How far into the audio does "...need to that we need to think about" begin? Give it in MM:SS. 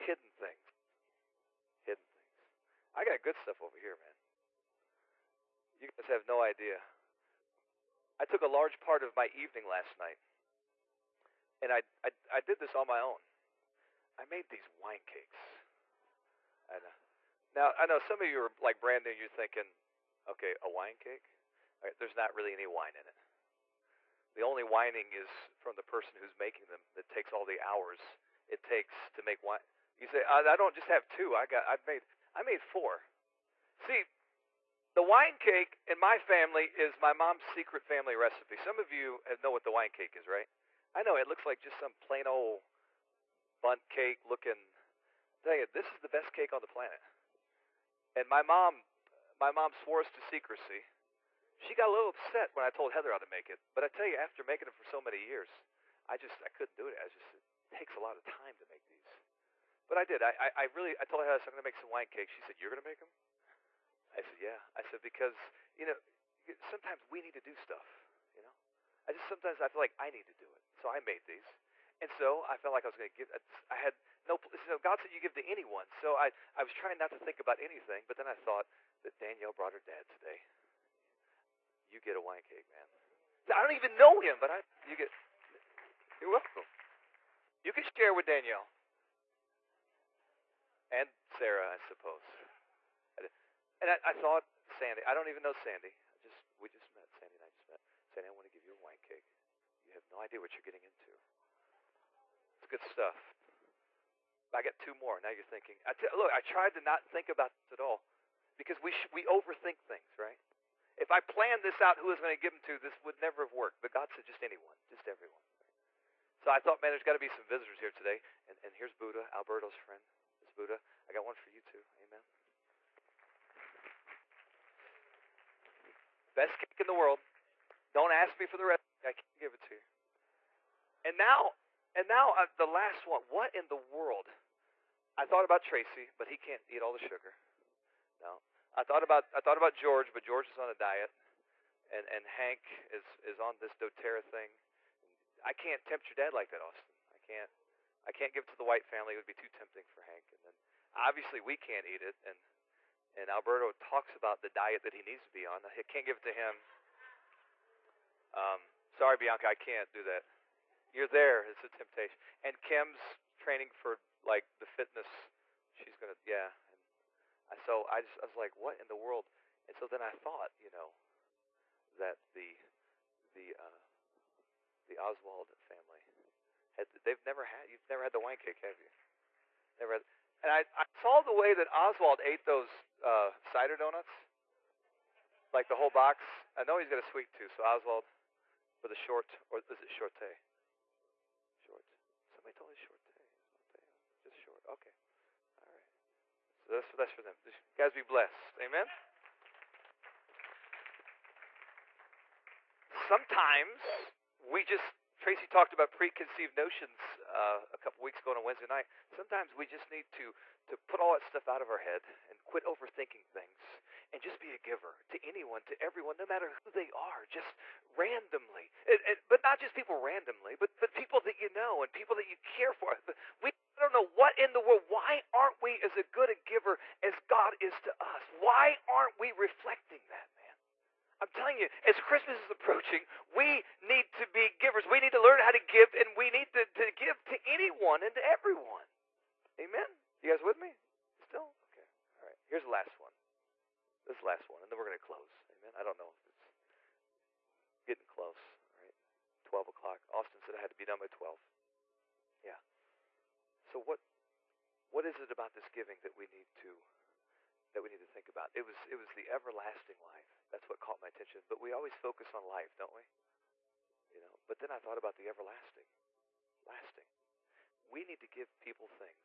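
04:16.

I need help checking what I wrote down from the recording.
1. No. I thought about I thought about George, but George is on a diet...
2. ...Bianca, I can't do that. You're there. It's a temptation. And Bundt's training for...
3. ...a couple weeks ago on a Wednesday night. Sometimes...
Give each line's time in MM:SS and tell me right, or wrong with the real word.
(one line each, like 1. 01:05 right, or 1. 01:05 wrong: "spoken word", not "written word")
1. 02:18 right
2. 02:39 wrong: "Kim", not "Bundt"
3. 03:27 right.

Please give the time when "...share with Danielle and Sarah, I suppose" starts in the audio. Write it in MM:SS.
01:27.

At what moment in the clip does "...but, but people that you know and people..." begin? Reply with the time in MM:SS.
03:40.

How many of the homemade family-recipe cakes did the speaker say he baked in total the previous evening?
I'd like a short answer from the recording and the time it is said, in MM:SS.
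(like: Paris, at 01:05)
4, at 00:32.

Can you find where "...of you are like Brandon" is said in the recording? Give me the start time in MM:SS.
00:18.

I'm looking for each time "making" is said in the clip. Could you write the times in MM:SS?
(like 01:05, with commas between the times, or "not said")
00:26, 00:54.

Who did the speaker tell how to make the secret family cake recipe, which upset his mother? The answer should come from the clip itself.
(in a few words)
Heather.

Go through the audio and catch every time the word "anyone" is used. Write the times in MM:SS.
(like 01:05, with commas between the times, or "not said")
01:15, 01:54, 03:35, 03:57.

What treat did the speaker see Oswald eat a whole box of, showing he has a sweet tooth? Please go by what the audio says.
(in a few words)
cider donuts.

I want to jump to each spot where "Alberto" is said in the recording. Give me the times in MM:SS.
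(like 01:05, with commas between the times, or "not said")
01:59, 02:33.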